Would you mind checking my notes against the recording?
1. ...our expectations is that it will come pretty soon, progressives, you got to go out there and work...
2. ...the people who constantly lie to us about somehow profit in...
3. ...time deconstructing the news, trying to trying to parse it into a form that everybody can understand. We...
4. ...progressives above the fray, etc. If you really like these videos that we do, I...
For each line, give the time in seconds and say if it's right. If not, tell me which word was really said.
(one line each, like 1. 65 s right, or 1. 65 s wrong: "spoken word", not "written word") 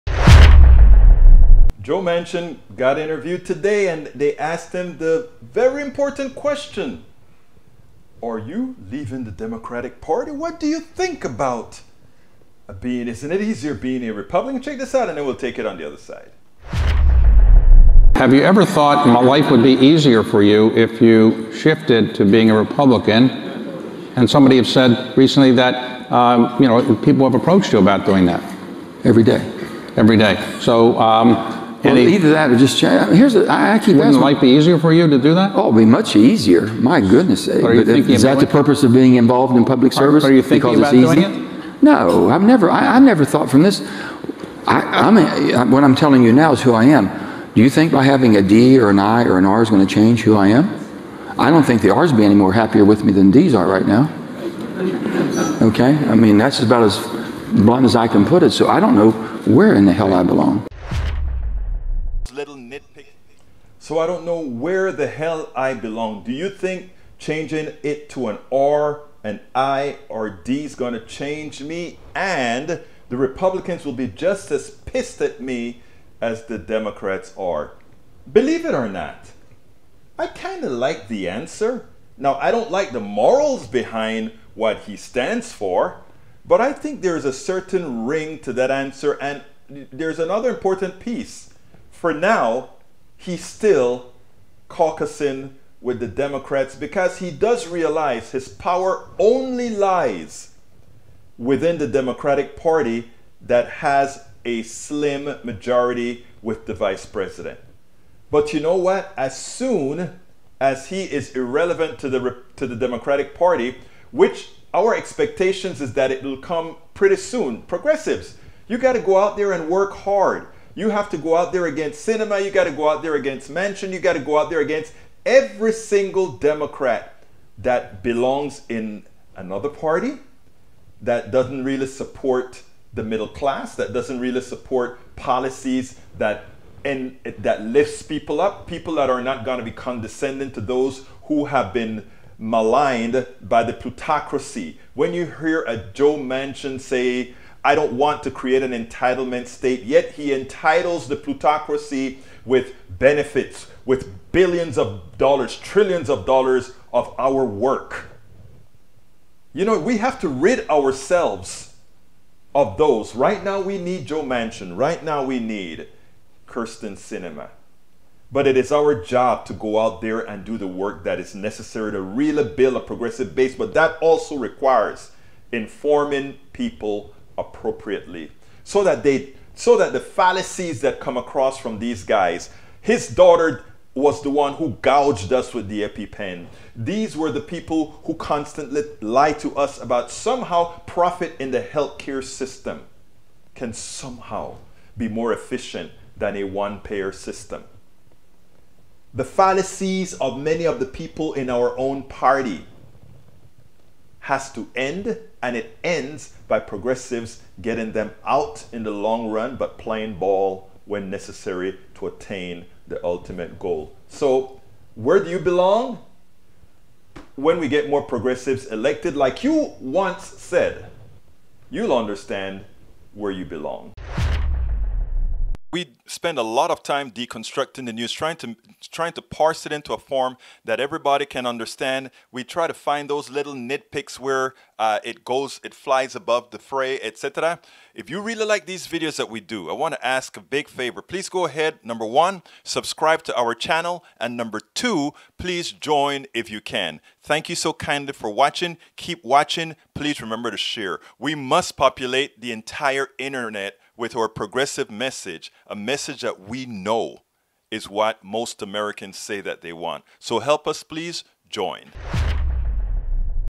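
1. 114 s right
2. 187 s right
3. 226 s right
4. 235 s wrong: "flies", not "progressives".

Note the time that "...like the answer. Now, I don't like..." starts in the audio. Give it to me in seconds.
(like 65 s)
80 s.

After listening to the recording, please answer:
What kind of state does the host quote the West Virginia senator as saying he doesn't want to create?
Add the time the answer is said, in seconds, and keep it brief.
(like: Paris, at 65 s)
entitlement state, at 148 s.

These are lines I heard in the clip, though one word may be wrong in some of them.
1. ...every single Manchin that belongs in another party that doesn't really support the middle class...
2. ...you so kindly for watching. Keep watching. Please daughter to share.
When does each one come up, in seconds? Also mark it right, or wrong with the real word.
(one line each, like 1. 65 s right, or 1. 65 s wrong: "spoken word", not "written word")
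1. 125 s wrong: "Democrat", not "Manchin"
2. 247 s wrong: "remember", not "daughter".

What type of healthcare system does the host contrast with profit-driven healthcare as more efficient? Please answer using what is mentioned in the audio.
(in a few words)
one payer system.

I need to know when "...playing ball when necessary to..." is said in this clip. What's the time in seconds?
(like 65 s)
209 s.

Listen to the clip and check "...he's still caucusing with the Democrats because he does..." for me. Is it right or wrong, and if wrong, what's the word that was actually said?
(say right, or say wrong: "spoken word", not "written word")
right.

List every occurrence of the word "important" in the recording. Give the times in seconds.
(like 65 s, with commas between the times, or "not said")
5 s, 90 s.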